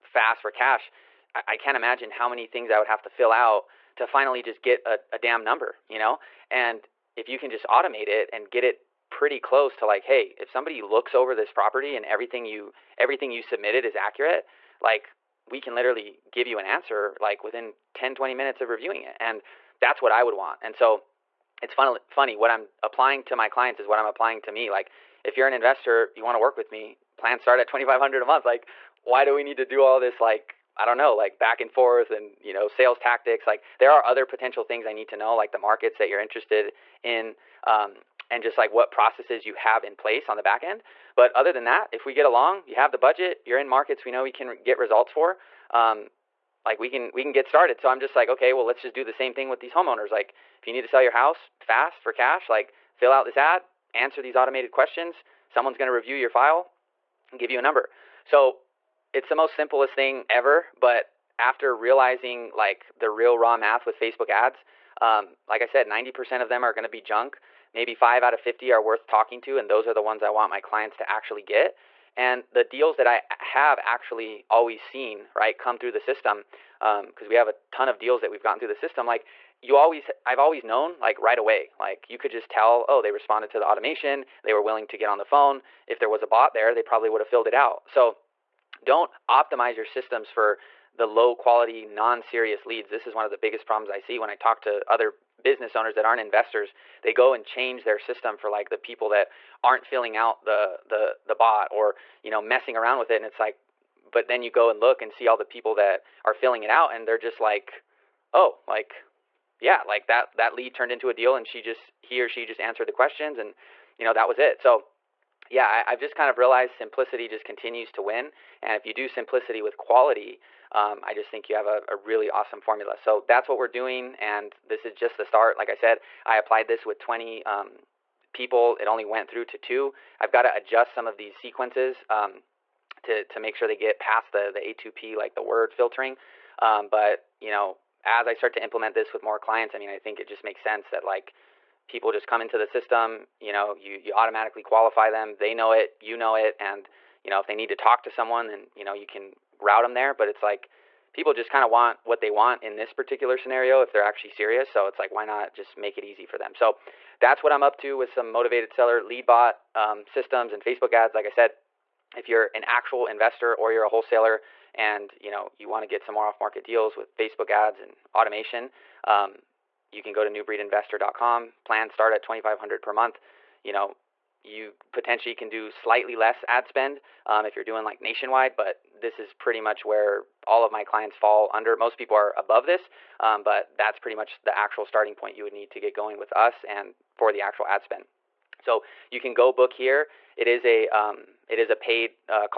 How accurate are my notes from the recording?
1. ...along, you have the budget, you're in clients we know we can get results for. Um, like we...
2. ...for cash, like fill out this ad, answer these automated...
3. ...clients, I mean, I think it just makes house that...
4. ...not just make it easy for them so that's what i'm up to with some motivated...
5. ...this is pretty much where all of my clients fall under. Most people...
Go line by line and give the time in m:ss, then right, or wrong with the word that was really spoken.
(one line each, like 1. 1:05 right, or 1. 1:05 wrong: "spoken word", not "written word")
1. 0:42 wrong: "markets", not "clients"
2. 0:52 right
3. 2:19 wrong: "sense", not "house"
4. 2:35 right
5. 2:58 right.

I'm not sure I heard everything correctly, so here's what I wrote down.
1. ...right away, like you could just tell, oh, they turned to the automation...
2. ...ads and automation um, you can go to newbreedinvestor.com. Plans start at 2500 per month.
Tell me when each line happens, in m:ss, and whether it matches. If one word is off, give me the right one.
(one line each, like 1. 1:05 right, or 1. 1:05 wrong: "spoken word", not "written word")
1. 1:21 wrong: "responded", not "turned"
2. 2:47 right.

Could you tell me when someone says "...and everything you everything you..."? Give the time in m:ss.
0:11.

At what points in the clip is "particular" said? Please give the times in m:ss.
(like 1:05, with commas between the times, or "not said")
2:32.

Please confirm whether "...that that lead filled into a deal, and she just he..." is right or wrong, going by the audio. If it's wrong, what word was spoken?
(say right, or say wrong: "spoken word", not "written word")
wrong: "turned", not "filled".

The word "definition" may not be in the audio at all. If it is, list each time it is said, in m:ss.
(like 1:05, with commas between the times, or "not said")
not said.